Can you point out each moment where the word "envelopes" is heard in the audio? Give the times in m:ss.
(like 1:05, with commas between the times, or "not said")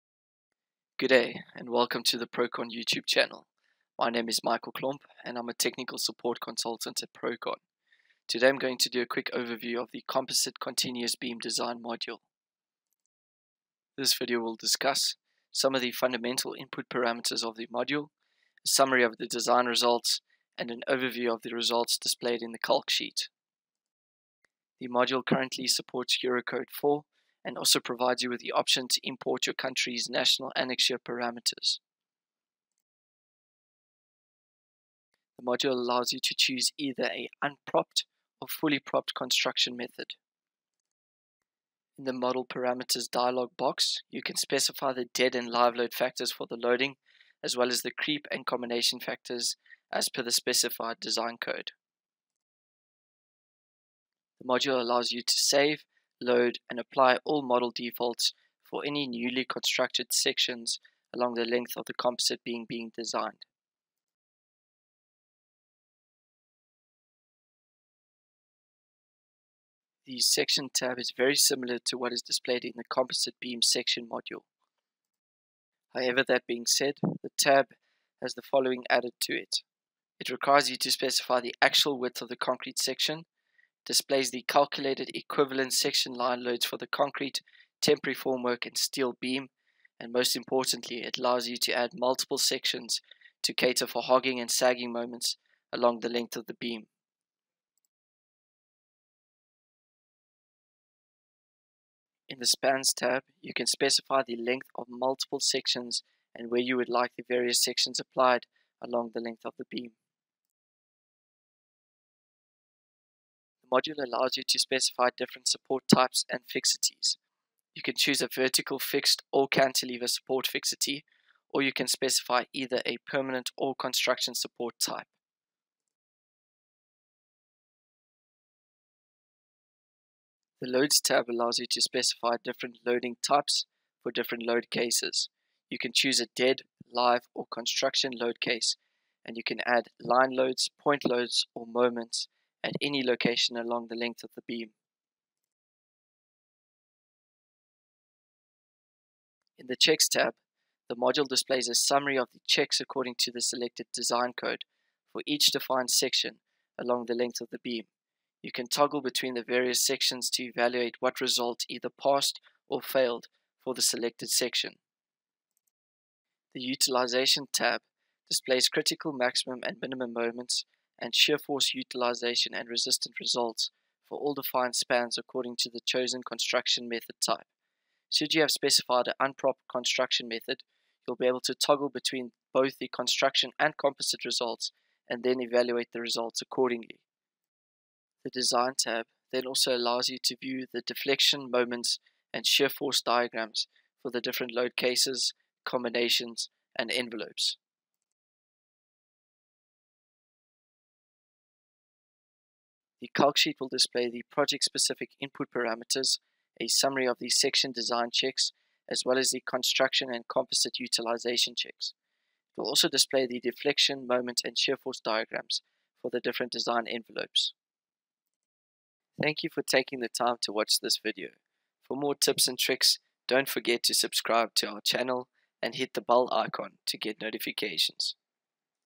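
3:16, 3:36.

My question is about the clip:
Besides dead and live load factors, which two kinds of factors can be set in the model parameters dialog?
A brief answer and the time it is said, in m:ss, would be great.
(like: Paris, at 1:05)
creep and combination, at 0:47.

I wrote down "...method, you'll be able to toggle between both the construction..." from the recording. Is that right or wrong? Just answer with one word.
right.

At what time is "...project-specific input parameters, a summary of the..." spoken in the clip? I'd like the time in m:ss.
3:24.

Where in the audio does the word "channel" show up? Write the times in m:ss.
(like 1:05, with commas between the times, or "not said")
0:03, 3:44.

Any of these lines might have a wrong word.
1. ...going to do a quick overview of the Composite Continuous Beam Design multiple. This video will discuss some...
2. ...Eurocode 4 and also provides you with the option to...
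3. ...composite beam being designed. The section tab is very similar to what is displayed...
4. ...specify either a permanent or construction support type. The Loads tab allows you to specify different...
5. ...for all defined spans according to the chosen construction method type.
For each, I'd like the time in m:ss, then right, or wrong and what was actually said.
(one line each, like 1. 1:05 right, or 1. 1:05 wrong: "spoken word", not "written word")
1. 0:08 wrong: "module", not "multiple"
2. 0:26 right
3. 1:01 right
4. 2:01 right
5. 2:54 right.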